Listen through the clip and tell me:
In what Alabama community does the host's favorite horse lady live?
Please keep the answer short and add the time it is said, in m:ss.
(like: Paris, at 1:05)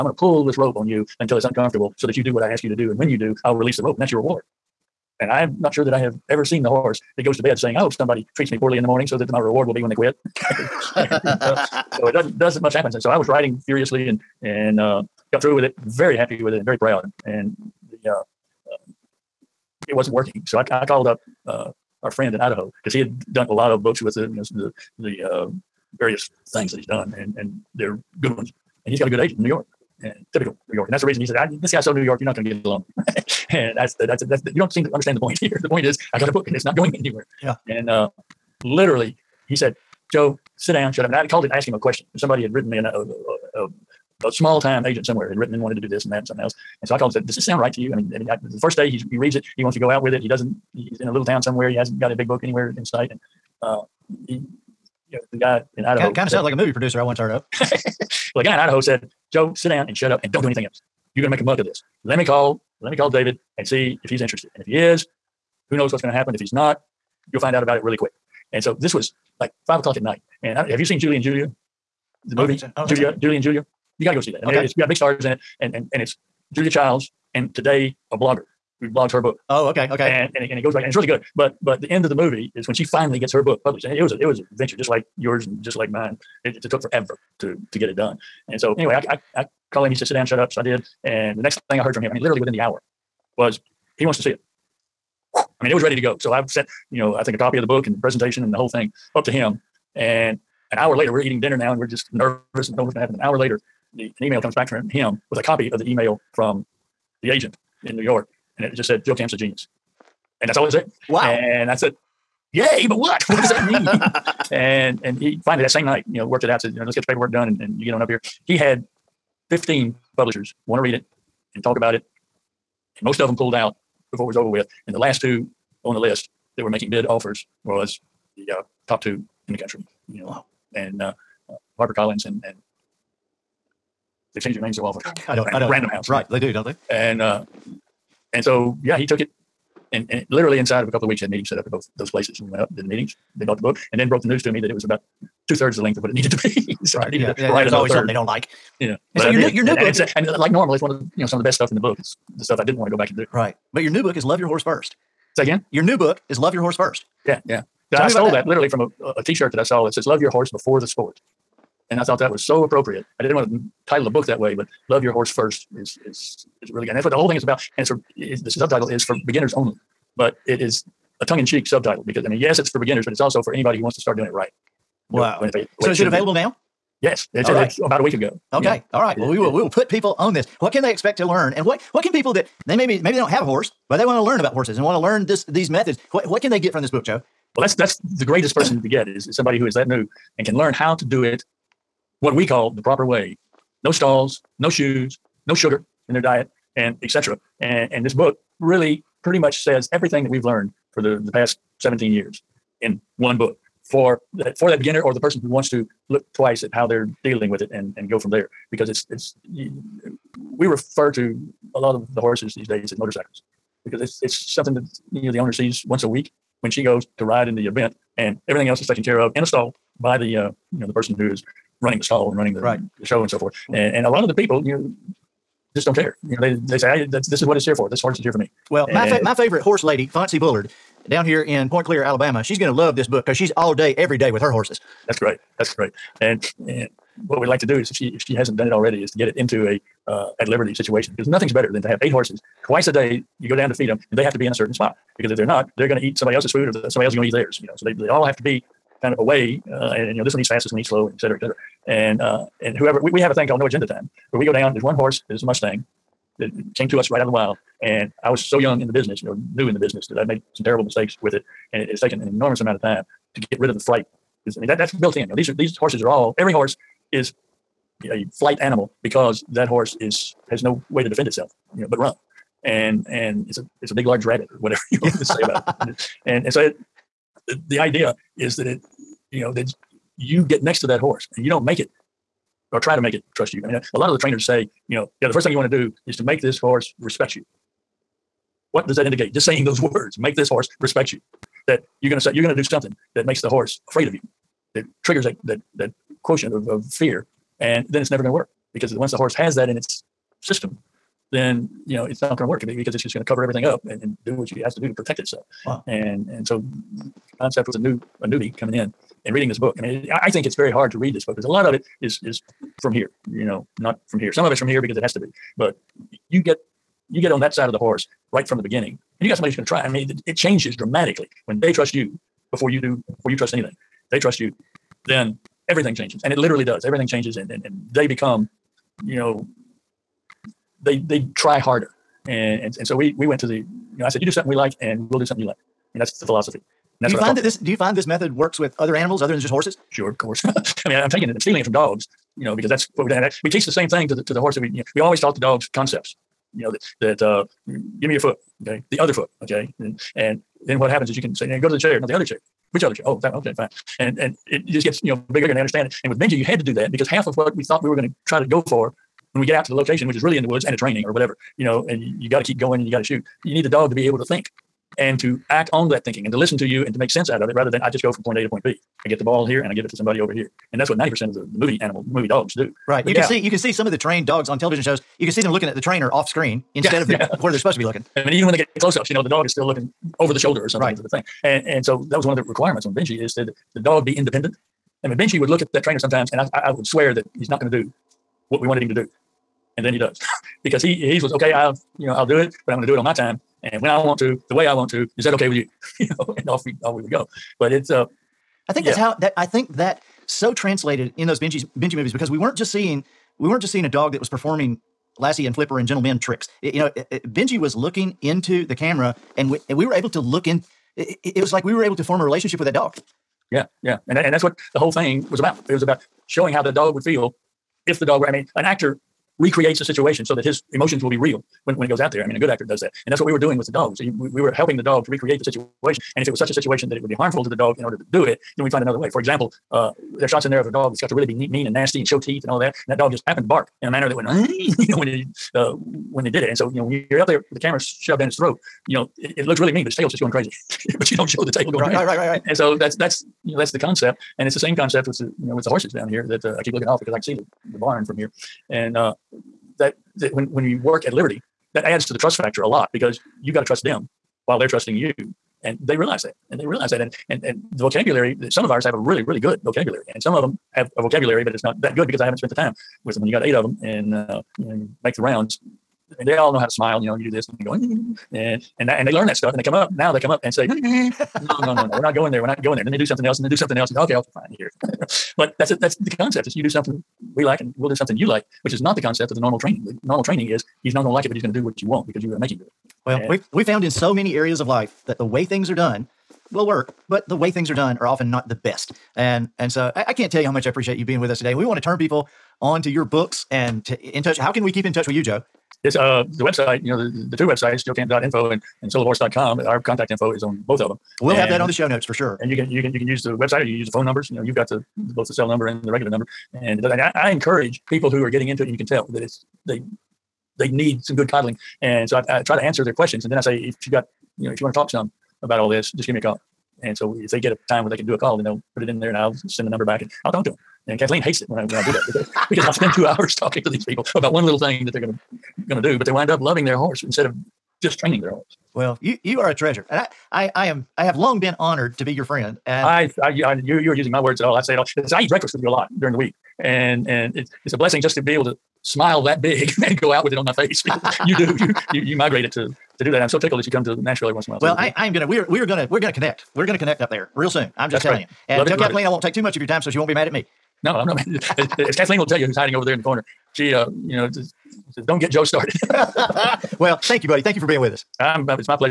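Point Clear, at 3:51.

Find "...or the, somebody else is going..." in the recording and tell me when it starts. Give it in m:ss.
4:06.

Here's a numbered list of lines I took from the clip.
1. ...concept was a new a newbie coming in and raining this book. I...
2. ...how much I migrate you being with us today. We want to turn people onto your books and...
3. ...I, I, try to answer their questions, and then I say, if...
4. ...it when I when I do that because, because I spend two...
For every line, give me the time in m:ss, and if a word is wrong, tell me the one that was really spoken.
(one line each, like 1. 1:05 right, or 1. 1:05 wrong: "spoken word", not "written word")
1. 5:07 wrong: "reading", not "raining"
2. 8:10 wrong: "appreciate", not "migrate"
3. 8:32 right
4. 8:41 right.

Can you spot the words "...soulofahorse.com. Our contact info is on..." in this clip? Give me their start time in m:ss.
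8:18.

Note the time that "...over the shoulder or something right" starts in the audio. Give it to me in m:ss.
6:20.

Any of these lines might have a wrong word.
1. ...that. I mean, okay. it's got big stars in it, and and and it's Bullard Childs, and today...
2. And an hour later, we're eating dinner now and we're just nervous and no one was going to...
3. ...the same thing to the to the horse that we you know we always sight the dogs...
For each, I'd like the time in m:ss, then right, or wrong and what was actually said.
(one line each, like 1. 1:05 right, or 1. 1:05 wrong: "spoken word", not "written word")
1. 1:14 wrong: "Julia", not "Bullard"
2. 1:39 right
3. 5:43 wrong: "taught", not "sight".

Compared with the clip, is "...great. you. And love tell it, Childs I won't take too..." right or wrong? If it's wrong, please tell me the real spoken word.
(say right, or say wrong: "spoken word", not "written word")
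wrong: "Kathleen", not "Childs".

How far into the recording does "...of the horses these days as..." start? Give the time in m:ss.
3:31.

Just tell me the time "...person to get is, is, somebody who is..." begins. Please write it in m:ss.
3:08.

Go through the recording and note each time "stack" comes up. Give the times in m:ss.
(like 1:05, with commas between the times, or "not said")
not said.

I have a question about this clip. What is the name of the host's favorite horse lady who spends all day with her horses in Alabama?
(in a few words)
Fonzie Bullard.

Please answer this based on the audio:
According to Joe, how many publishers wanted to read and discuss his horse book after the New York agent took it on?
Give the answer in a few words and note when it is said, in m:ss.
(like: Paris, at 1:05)
15, at 1:59.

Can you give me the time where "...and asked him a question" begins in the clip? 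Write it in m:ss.
0:41.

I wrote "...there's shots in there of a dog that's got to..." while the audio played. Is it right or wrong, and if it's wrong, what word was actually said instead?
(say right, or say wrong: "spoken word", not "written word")
right.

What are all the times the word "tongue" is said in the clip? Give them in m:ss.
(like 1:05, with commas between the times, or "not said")
2:51.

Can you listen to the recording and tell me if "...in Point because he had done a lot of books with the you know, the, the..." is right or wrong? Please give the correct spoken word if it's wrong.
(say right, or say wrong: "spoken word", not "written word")
wrong: "Idaho", not "Point".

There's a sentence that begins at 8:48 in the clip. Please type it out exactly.
Well, you you are a treasure.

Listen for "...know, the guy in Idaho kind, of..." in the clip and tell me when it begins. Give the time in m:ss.
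0:55.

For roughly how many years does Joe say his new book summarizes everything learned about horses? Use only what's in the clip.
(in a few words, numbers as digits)
17.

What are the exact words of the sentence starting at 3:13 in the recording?
No stalls, no shoes, no sugar in their diet, and etc.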